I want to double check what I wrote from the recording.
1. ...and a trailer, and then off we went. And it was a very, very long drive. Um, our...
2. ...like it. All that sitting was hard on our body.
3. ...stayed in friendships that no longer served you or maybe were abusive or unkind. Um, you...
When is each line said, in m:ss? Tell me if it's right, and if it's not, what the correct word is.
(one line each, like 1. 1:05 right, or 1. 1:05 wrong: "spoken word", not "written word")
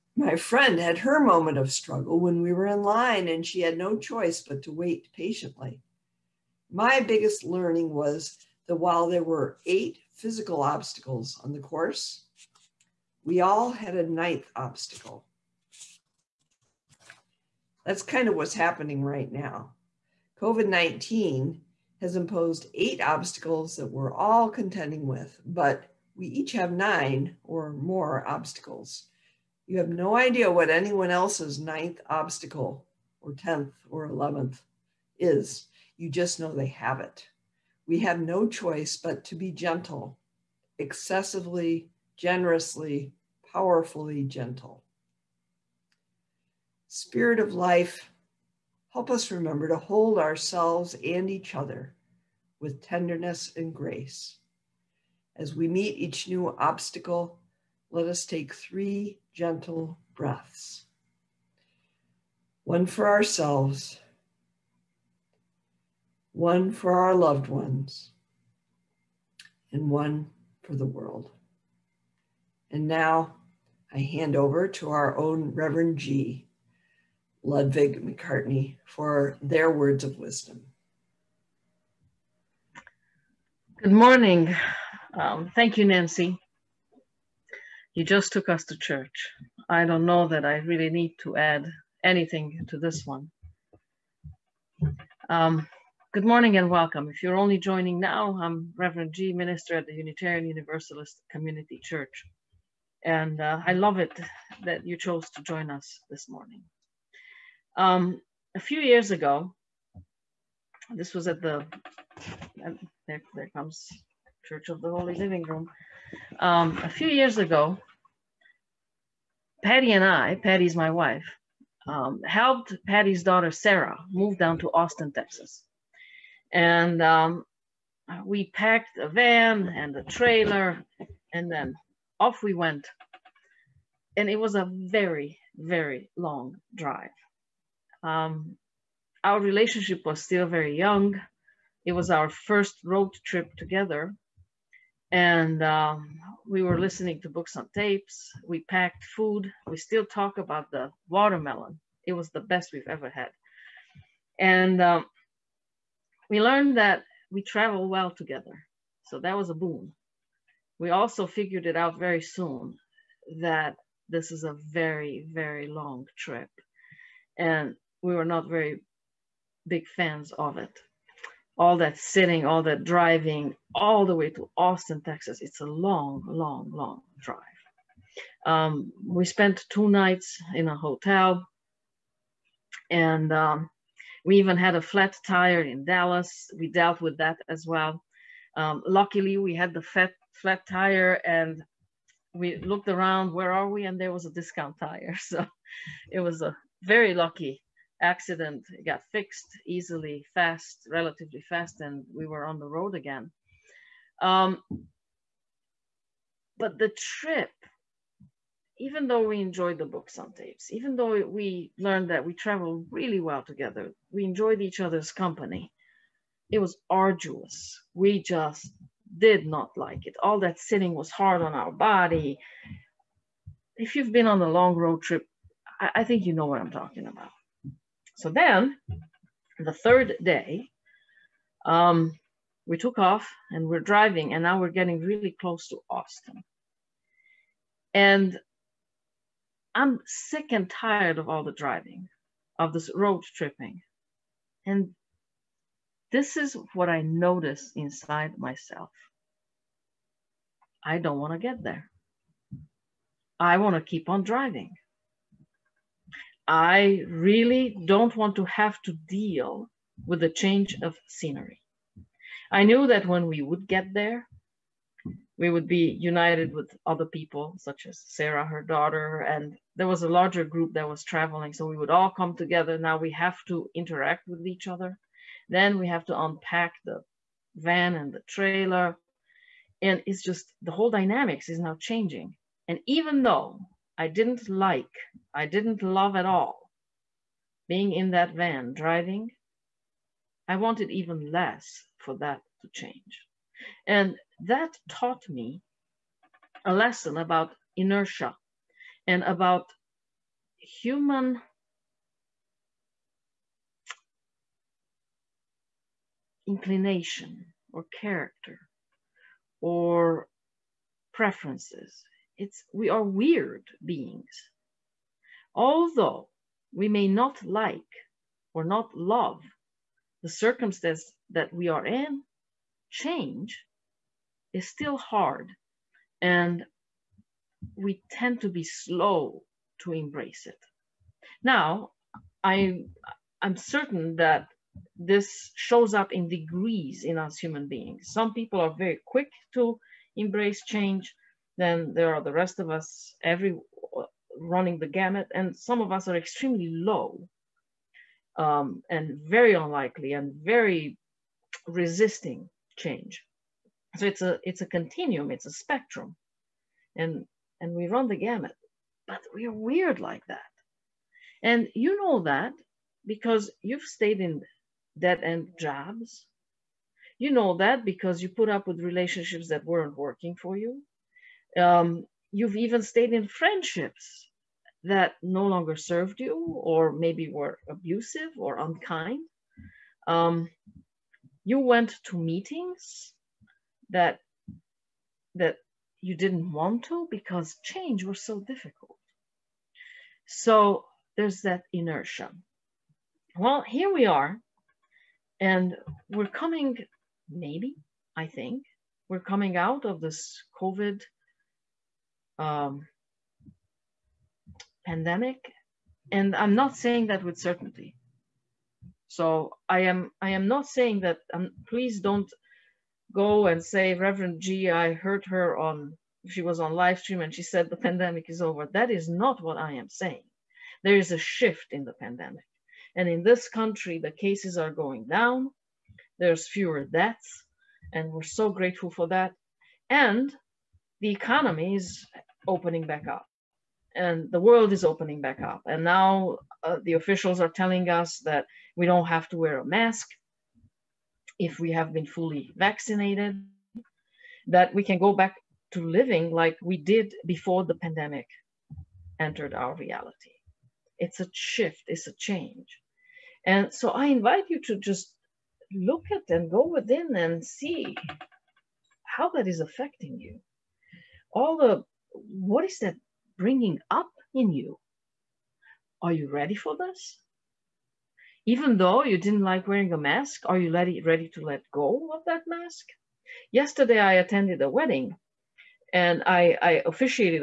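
1. 2:09 right
2. 3:39 right
3. 6:12 right.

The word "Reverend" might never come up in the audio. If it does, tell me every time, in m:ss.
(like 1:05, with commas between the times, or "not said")
1:15, 1:38, 6:53.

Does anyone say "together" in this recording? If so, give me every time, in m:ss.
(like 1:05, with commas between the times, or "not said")
2:23, 2:38, 3:33, 4:32.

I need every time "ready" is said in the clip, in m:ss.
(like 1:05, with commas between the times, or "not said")
7:46, 7:50.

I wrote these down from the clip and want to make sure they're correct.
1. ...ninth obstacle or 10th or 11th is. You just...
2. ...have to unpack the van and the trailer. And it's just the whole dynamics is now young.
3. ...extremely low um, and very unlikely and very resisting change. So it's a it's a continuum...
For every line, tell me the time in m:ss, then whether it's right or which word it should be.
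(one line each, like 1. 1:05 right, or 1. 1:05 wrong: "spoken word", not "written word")
1. 0:31 right
2. 4:35 wrong: "changing", not "young"
3. 5:46 right.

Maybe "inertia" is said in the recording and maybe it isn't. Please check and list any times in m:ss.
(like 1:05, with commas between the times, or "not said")
4:57, 6:31.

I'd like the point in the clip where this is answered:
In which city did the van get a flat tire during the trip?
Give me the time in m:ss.
3:05.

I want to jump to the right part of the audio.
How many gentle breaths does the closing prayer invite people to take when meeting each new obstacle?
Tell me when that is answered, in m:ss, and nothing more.
0:58.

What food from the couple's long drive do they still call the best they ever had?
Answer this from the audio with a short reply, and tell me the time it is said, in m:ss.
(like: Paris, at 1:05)
Watermelon, at 2:31.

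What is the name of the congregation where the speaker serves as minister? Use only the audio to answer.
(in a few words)
Unitarian Universalist Community Church.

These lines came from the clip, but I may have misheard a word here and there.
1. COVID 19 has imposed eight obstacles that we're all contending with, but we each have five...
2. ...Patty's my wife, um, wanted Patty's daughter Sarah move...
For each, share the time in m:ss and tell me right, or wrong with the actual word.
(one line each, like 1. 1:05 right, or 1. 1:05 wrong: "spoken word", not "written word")
1. 0:20 wrong: "nine", not "five"
2. 2:00 wrong: "helped", not "wanted".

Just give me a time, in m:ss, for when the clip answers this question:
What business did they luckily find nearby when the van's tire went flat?
3:14.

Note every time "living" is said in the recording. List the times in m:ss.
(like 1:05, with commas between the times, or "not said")
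1:55, 7:25.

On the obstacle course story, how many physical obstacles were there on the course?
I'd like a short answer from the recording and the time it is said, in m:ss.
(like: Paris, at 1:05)
8, at 0:09.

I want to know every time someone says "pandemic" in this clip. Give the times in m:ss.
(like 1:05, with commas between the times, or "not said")
6:44, 6:57, 7:01, 7:27.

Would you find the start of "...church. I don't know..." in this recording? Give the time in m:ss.
1:28.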